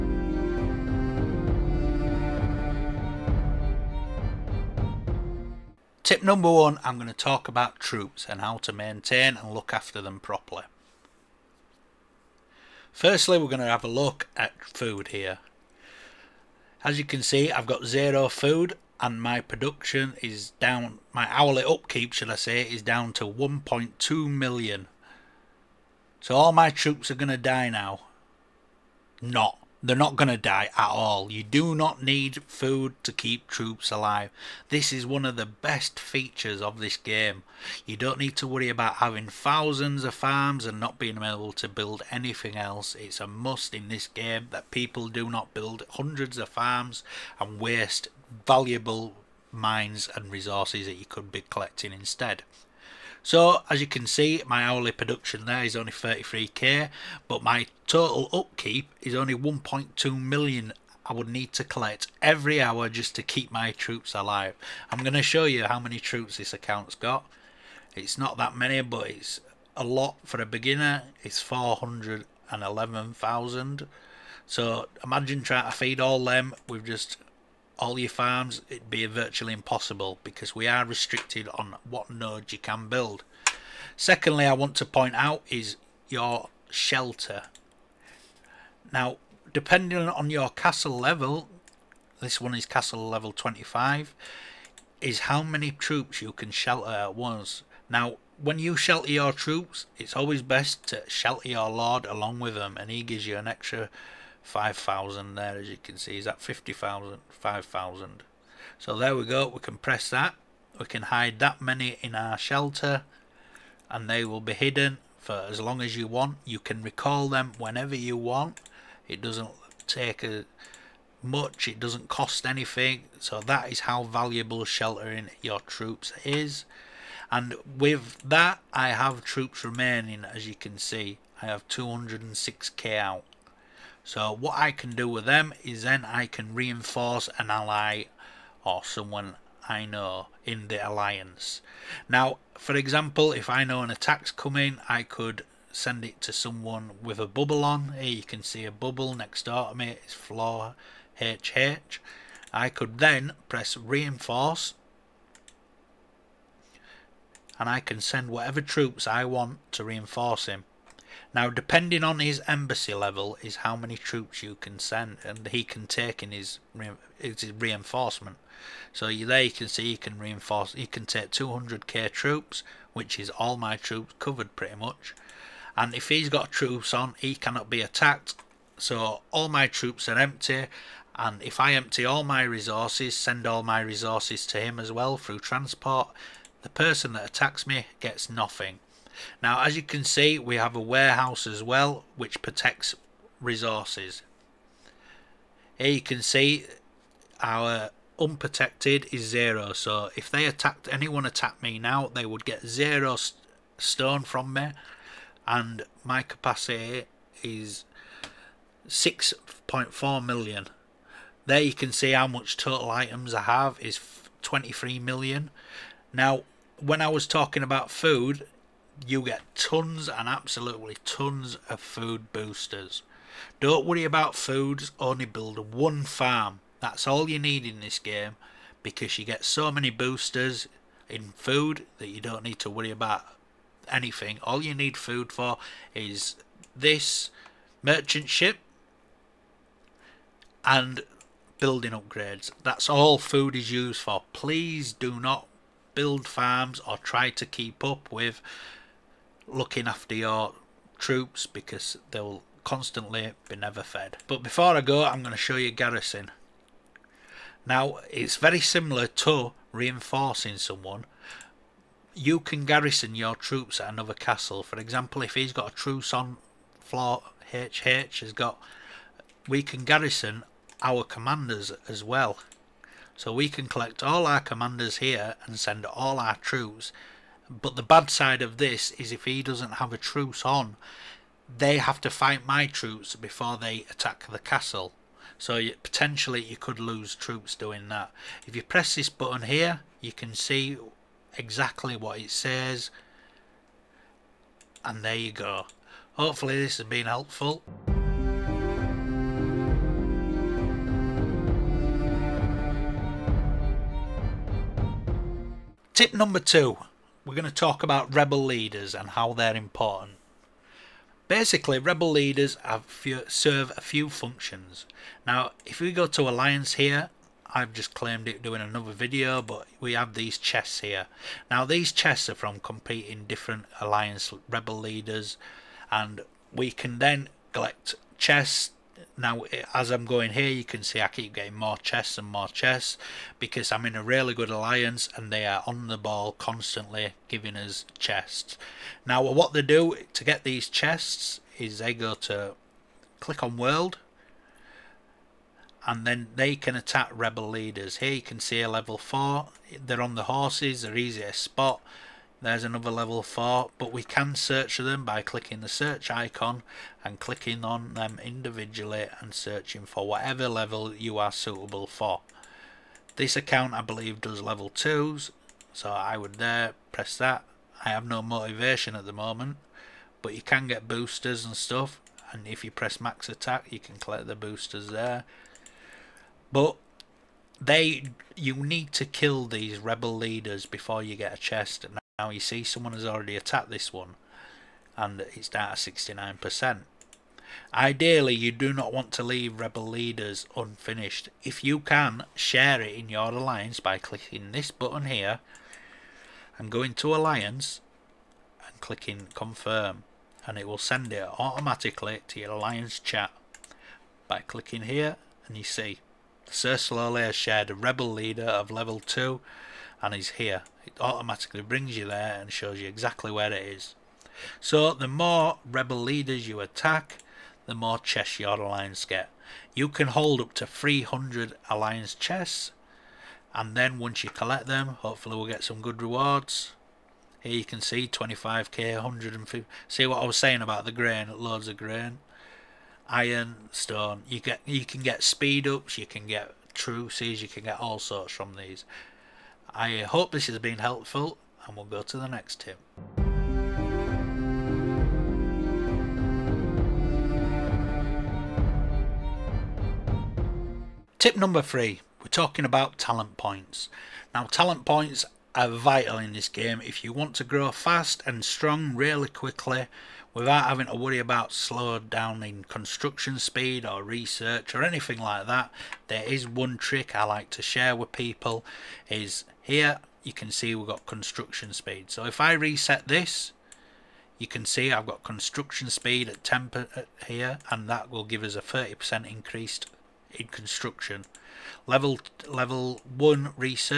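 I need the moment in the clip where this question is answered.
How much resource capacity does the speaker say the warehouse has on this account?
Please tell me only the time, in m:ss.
3:28.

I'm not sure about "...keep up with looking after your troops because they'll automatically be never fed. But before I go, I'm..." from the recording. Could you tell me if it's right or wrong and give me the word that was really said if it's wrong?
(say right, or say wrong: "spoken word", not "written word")
wrong: "constantly", not "automatically".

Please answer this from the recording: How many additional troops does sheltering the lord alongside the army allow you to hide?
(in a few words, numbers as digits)
5,000.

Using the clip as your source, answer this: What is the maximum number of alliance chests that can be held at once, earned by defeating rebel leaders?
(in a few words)
300.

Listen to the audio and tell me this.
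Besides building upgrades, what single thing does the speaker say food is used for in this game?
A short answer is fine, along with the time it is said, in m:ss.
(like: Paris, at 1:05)
Merchant ship, at 3:57.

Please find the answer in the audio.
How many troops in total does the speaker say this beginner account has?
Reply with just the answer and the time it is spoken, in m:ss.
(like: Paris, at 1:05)
411,000, at 1:11.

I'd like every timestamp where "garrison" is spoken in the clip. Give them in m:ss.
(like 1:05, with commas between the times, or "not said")
4:15, 4:22, 4:29.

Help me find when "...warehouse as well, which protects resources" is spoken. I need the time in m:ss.
3:10.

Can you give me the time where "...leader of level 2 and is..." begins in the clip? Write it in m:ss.
6:48.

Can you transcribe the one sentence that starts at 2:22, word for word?
Now, for example, if I know an attack's coming, I could send it to someone with a bubble on.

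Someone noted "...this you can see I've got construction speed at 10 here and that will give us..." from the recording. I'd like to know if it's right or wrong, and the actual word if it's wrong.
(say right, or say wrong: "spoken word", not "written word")
right.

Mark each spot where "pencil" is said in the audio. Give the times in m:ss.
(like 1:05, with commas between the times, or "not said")
not said.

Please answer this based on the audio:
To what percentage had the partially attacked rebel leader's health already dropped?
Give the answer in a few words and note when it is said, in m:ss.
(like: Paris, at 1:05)
69%, at 6:25.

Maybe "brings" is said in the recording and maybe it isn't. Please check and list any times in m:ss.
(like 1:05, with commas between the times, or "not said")
6:51.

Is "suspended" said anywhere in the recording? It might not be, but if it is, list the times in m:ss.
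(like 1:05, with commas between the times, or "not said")
not said.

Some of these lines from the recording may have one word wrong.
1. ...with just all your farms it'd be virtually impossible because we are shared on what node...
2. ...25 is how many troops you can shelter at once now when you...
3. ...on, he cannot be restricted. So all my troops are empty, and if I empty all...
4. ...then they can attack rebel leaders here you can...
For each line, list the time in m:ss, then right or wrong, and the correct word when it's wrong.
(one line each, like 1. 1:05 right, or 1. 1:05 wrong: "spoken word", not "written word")
1. 1:16 wrong: "restricted", not "shared"
2. 1:33 right
3. 2:56 wrong: "attacked", not "restricted"
4. 5:46 right.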